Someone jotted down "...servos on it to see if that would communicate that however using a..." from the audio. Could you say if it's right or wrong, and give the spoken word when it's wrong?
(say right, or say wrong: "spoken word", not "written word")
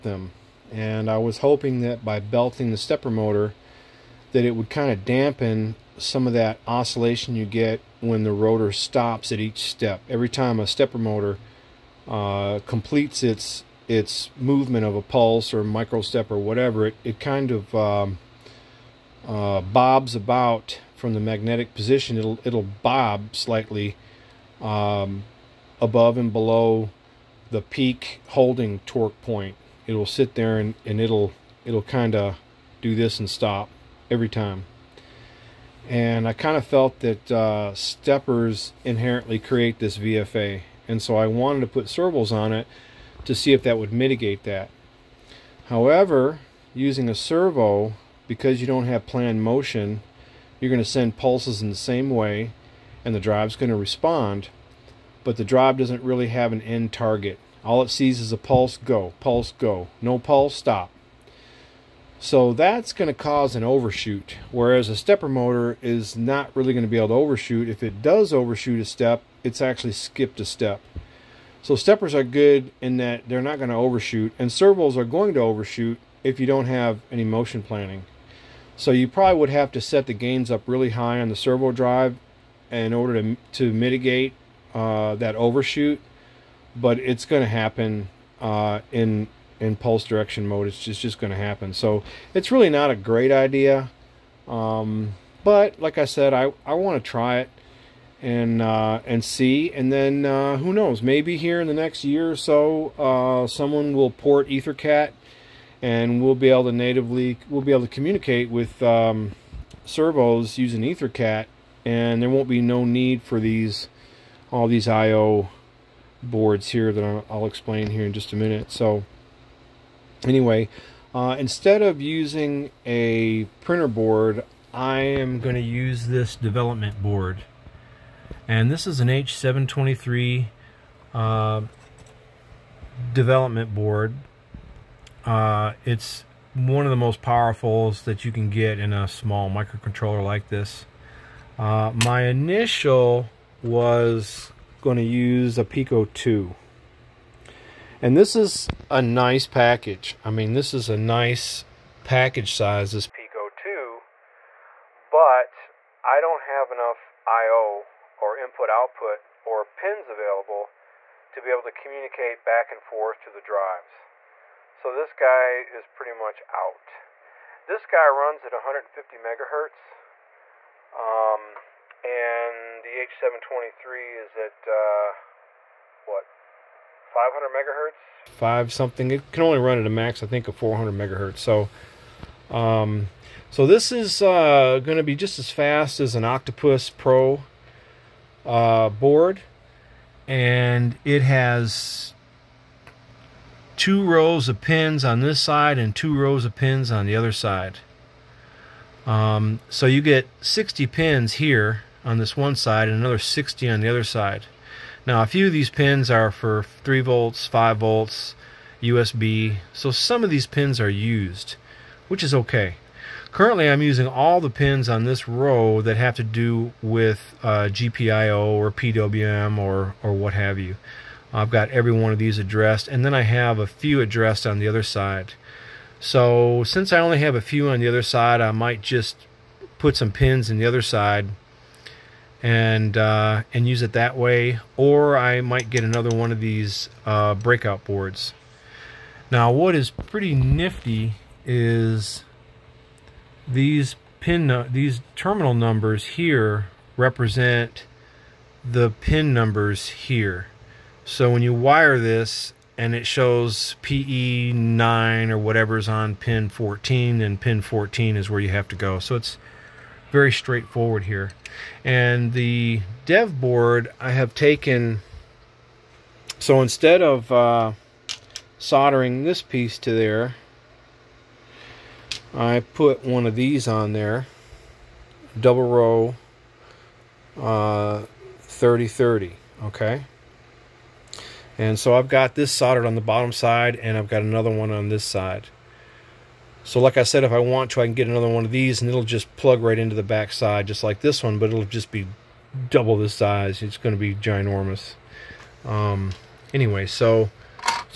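wrong: "mitigate", not "communicate".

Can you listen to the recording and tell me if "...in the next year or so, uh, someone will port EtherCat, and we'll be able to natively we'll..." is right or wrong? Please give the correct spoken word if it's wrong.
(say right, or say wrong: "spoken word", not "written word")
right.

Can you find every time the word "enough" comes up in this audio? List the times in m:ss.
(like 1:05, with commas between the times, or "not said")
2:36.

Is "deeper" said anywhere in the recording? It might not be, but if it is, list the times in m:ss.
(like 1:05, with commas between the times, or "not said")
not said.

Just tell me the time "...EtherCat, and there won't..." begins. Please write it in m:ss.
1:50.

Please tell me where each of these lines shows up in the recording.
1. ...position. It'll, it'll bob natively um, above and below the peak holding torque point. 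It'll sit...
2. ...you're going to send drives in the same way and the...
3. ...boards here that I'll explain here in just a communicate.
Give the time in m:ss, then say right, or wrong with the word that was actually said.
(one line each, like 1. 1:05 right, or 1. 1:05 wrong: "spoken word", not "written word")
1. 0:21 wrong: "slightly", not "natively"
2. 0:50 wrong: "pulses", not "drives"
3. 1:56 wrong: "minute", not "communicate".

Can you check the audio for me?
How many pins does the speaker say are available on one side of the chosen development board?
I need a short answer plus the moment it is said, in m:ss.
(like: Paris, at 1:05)
60, at 3:20.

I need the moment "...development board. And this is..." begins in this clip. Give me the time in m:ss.
2:06.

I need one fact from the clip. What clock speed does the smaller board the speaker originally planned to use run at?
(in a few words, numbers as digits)
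150 megahertz.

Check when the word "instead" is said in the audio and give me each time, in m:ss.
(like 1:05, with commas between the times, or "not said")
2:01, 4:26.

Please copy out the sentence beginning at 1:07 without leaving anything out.
If it does overshoot a step, it's actually skipped a step.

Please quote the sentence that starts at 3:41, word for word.
I've got every one of these addressed and then I have a few addressed on the other side.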